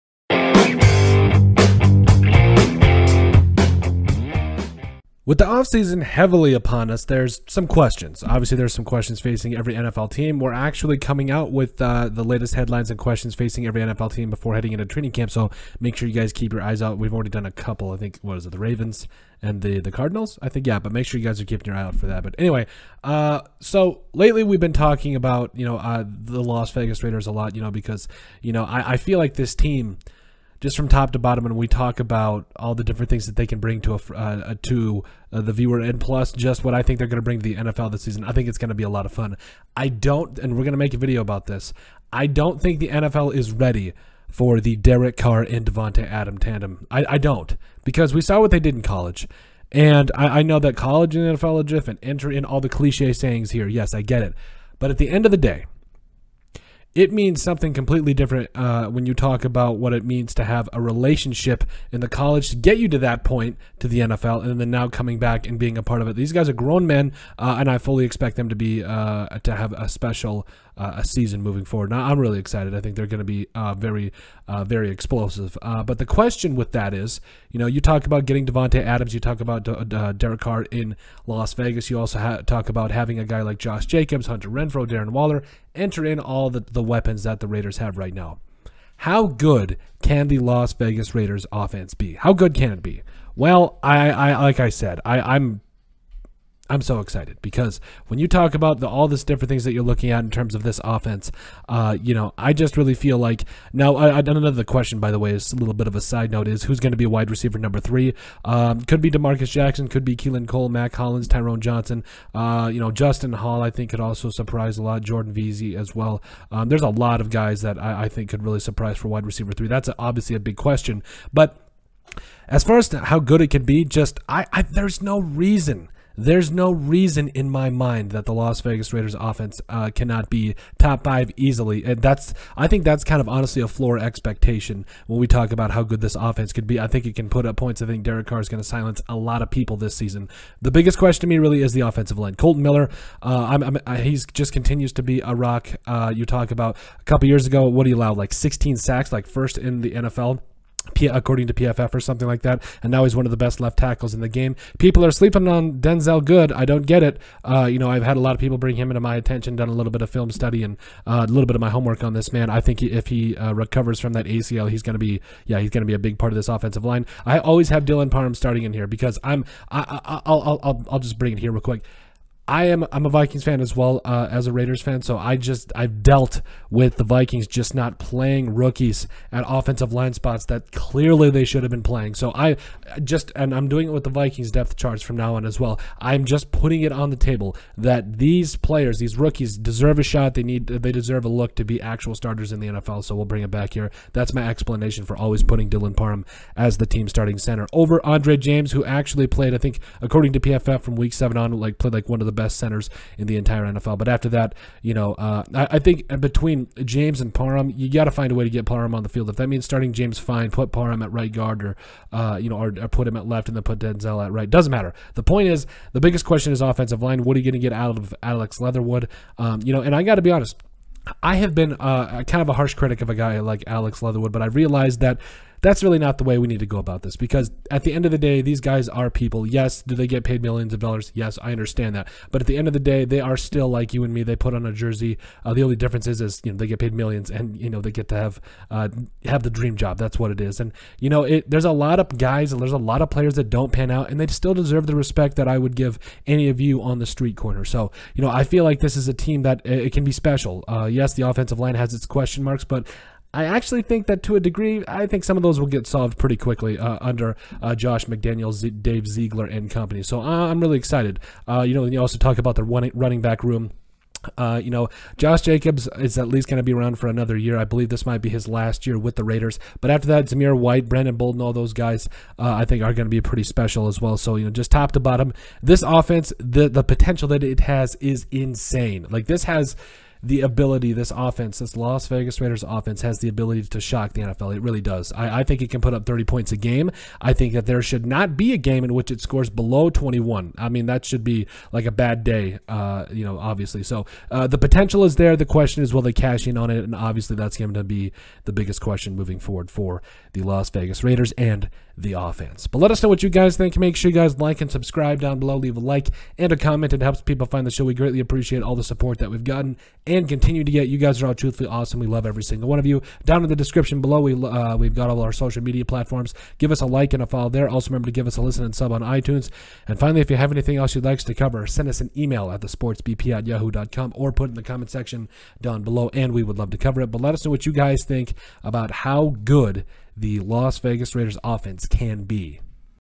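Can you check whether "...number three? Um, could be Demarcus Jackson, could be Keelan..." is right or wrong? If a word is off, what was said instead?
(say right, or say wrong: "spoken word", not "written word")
right.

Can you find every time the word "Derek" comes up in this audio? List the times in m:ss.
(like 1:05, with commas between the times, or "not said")
0:44, 1:20, 2:18.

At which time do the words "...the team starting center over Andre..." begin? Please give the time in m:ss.
3:16.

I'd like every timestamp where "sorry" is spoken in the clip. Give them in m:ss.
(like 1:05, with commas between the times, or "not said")
not said.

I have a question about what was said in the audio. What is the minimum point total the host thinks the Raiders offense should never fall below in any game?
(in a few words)
21.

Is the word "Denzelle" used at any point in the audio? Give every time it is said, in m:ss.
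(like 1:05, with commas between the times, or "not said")
2:35, 3:33.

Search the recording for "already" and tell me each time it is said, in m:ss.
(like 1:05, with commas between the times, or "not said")
0:17.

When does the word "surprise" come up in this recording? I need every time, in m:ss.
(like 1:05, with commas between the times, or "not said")
1:54, 1:58.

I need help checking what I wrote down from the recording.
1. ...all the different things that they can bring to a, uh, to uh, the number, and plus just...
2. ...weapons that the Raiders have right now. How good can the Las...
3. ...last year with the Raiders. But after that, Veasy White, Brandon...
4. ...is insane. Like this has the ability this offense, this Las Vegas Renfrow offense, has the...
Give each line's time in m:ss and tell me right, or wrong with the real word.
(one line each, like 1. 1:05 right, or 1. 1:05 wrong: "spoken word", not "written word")
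1. 0:32 wrong: "viewer", not "number"
2. 1:26 right
3. 4:28 wrong: "Zamir", not "Veasy"
4. 4:37 wrong: "Raiders", not "Renfrow".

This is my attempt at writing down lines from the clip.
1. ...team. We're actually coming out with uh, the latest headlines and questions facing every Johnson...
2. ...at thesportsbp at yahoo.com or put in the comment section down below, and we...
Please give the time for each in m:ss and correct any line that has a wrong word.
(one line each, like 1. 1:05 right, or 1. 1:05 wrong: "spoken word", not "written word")
1. 0:10 wrong: "NFL", not "Johnson"
2. 5:22 right.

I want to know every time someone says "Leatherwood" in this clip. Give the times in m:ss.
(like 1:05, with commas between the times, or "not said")
3:38, 3:44.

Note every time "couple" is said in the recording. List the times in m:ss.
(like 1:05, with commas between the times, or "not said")
0:17, 2:27.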